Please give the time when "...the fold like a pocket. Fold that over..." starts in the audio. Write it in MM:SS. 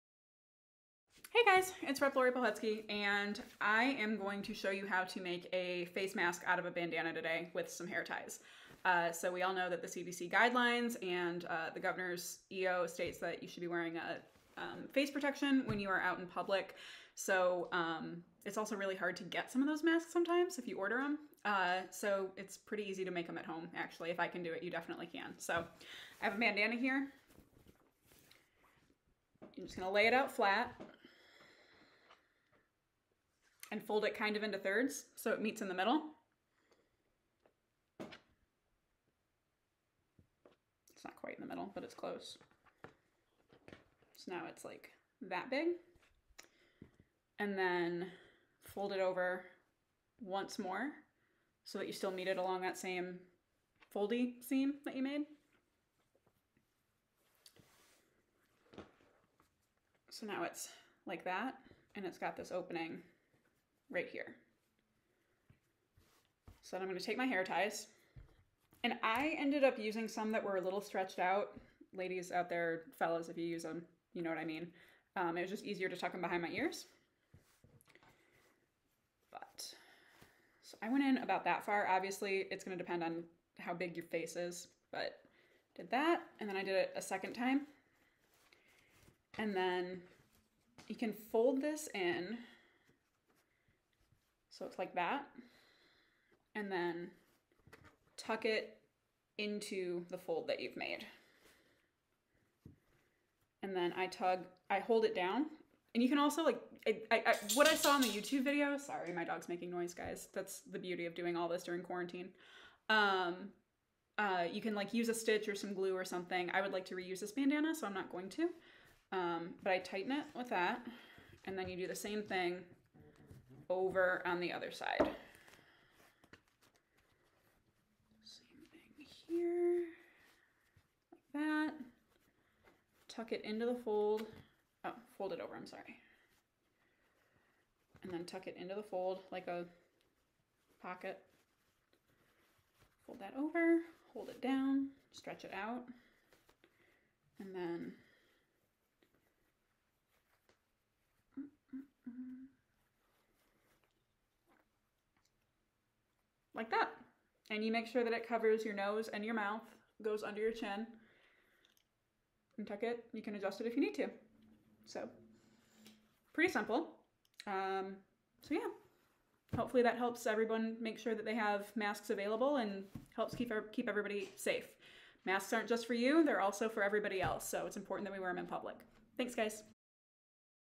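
02:18.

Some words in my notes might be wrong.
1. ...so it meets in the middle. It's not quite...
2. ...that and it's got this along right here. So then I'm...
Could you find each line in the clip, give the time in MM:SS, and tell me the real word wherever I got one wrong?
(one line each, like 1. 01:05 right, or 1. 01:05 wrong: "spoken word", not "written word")
1. 00:35 right
2. 01:01 wrong: "opening", not "along".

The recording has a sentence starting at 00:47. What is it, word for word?
And then fold it over once more so that you still meet it along that same foldy seam that you made.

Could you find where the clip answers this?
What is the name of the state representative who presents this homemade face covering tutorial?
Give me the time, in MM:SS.
00:02.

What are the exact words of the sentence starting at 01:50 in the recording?
That's the beauty of doing all this during quarantine.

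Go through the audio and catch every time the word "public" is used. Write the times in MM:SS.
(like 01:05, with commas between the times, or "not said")
00:16, 02:58.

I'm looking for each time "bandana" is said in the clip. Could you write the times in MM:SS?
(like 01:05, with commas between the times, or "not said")
00:06, 00:26, 01:57.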